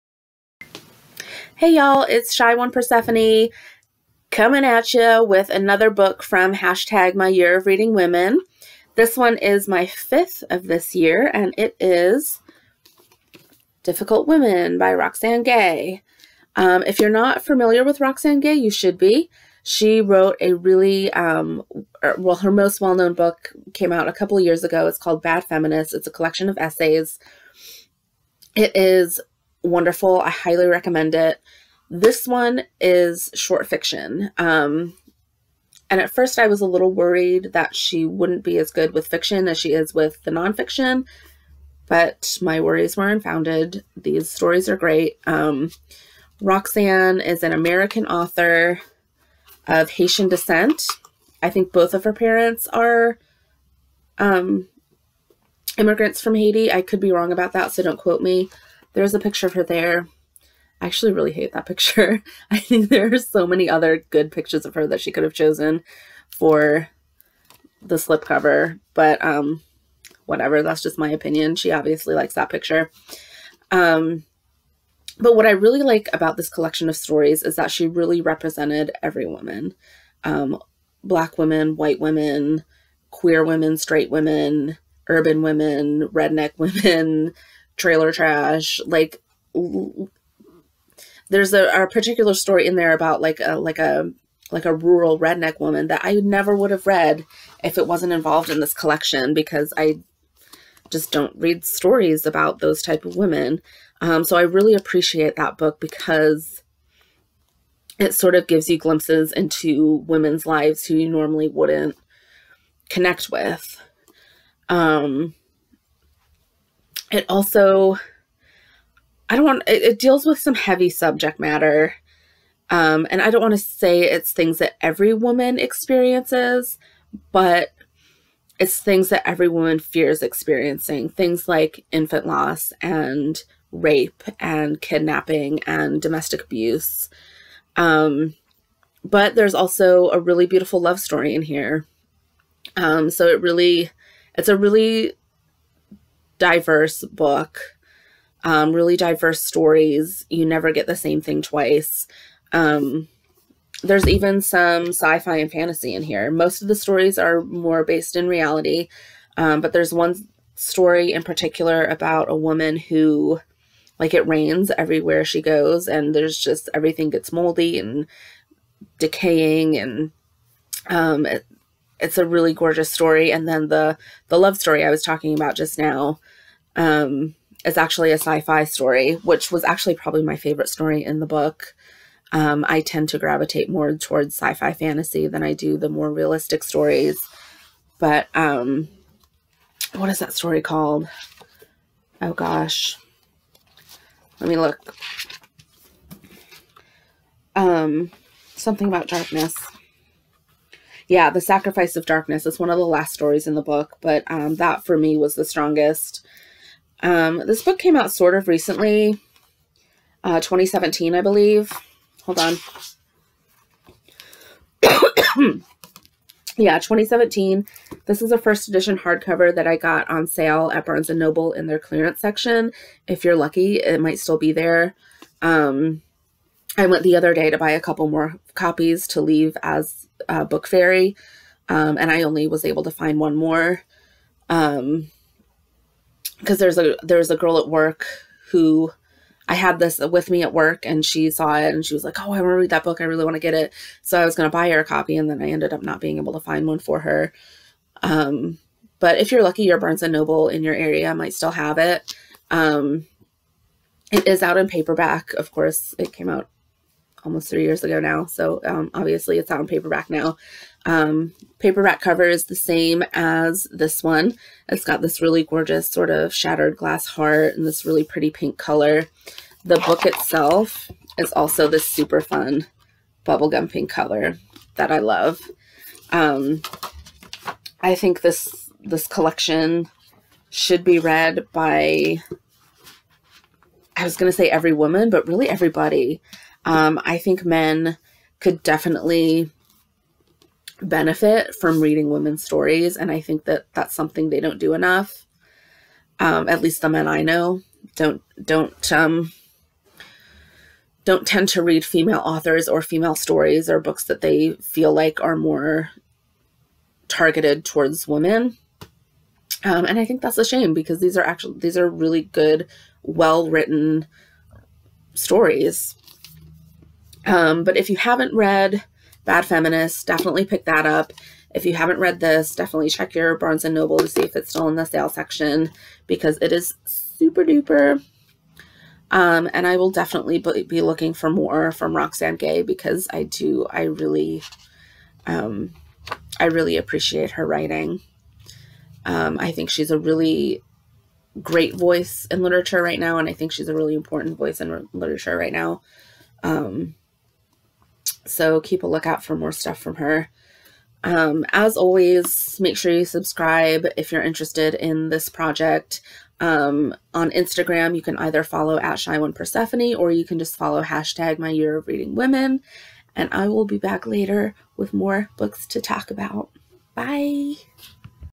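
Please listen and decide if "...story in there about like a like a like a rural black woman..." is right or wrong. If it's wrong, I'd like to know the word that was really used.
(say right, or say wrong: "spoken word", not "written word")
wrong: "redneck", not "black".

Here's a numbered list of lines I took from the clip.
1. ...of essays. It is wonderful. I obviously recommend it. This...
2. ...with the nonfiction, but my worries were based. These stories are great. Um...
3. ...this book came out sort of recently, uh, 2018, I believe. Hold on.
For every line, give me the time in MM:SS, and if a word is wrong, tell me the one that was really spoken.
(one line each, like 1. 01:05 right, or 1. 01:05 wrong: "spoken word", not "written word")
1. 00:26 wrong: "highly", not "obviously"
2. 00:39 wrong: "unfounded", not "based"
3. 03:27 wrong: "2017", not "2018".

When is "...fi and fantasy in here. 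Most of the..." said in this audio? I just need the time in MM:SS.
02:35.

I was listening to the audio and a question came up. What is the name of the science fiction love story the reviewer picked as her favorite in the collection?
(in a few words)
The Sacrifice of Darkness.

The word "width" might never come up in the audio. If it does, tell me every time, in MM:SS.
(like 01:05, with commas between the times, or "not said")
not said.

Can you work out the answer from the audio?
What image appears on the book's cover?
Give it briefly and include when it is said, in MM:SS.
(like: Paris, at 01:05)
shattered glass heart, at 04:26.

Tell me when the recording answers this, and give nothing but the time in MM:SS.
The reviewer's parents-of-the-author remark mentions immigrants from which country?
00:56.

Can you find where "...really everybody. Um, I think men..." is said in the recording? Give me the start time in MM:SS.
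04:45.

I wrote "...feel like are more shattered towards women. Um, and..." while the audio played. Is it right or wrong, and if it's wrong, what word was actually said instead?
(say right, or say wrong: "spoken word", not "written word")
wrong: "targeted", not "shattered".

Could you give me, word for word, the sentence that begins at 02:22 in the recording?
Um, so it really, it's a really diverse book, um, really diverse stories.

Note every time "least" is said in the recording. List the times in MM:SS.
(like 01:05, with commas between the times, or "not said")
04:56.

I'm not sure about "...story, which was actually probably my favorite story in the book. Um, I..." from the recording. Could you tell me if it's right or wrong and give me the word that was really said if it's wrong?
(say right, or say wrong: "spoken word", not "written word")
right.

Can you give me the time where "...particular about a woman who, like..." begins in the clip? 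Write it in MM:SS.
02:41.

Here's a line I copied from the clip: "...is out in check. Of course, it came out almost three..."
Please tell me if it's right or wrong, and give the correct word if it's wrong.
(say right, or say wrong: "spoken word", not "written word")
wrong: "paperback", not "check".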